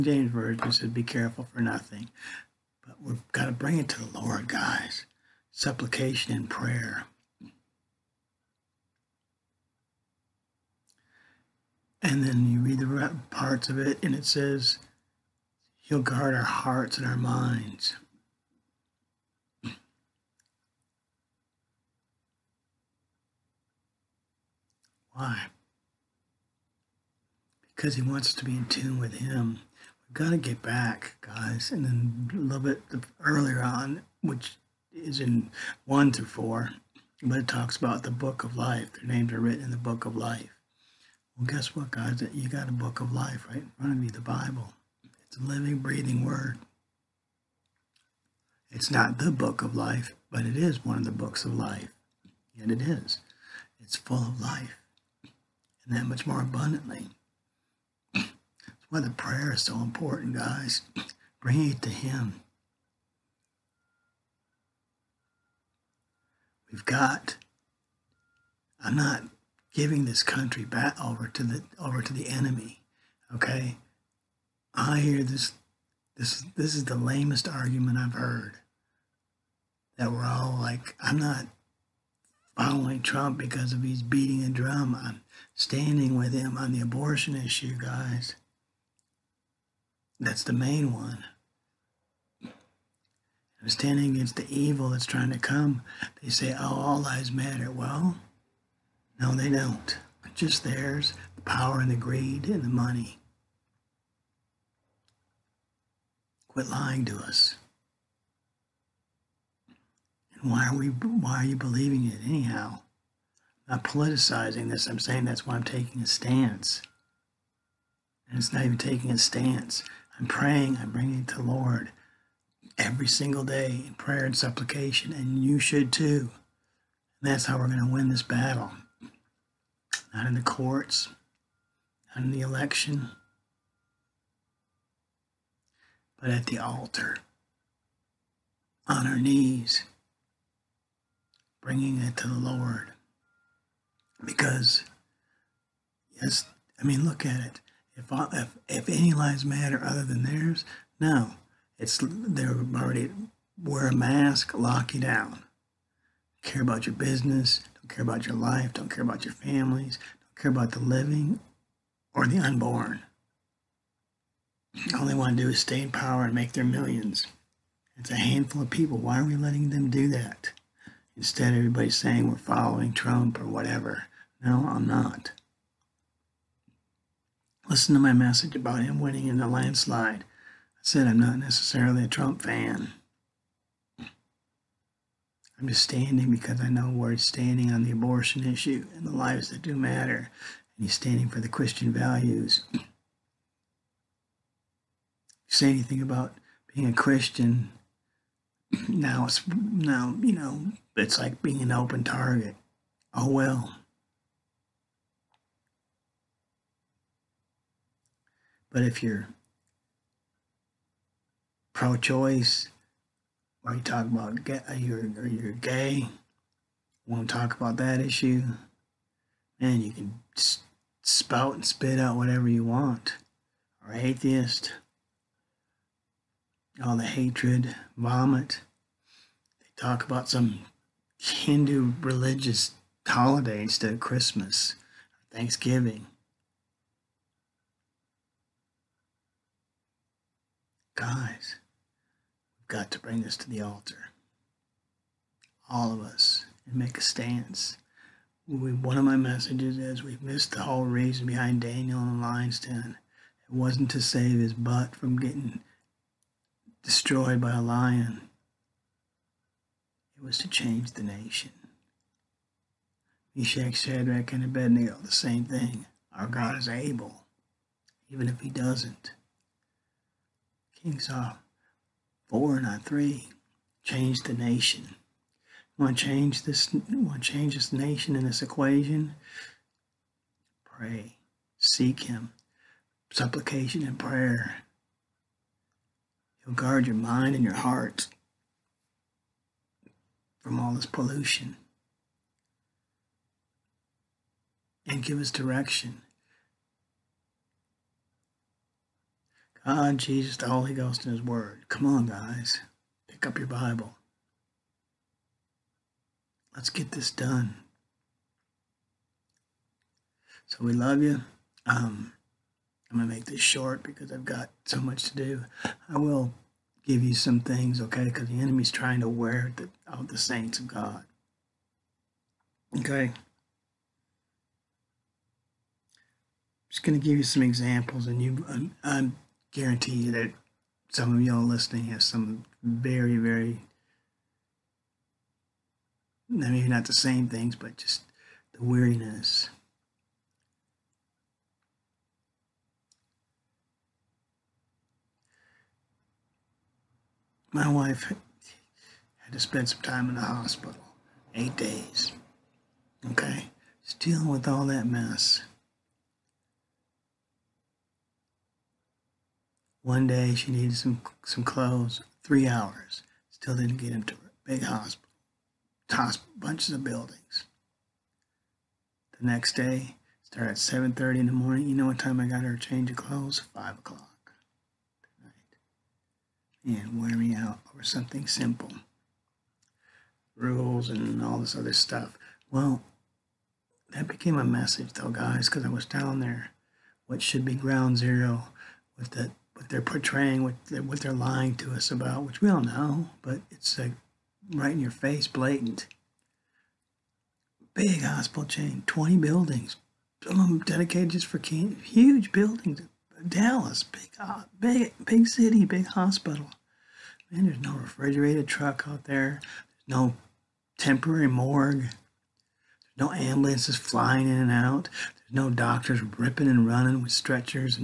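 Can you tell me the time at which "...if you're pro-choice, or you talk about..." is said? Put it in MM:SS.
03:28.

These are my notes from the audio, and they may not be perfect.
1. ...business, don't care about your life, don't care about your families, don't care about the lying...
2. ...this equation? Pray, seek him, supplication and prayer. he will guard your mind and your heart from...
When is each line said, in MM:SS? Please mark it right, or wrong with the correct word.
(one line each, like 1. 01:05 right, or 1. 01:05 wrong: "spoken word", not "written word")
1. 02:36 wrong: "living", not "lying"
2. 04:38 right.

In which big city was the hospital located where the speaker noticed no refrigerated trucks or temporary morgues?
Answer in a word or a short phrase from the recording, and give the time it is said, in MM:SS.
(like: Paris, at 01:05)
Dallas, at 06:43.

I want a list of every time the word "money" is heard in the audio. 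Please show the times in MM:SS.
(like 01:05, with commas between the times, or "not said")
01:42.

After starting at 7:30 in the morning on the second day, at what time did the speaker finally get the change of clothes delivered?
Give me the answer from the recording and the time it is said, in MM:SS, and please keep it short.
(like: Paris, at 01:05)
5 o'clock, at 06:13.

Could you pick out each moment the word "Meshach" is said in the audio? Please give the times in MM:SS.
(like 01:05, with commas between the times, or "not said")
04:23.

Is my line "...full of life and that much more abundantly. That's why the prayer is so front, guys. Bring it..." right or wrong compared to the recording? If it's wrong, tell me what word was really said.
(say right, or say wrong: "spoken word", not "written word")
wrong: "important", not "front".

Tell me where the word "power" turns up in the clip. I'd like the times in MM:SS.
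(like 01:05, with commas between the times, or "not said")
01:41, 02:45.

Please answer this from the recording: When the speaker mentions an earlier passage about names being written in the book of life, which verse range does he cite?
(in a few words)
1 through 4.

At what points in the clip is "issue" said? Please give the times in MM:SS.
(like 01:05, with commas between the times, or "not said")
01:27, 03:08, 03:38.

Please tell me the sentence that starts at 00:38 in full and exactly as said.
Their names are written in the book of life.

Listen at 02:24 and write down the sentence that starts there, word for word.
Because, yes, I mean, look at it.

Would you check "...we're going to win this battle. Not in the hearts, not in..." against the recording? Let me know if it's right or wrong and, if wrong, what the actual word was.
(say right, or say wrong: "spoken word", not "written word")
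wrong: "courts", not "hearts".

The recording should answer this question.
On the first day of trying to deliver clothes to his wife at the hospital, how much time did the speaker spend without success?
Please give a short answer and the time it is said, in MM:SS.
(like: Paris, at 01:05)
3 hours, at 06:02.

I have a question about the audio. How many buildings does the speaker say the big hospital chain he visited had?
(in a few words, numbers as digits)
20.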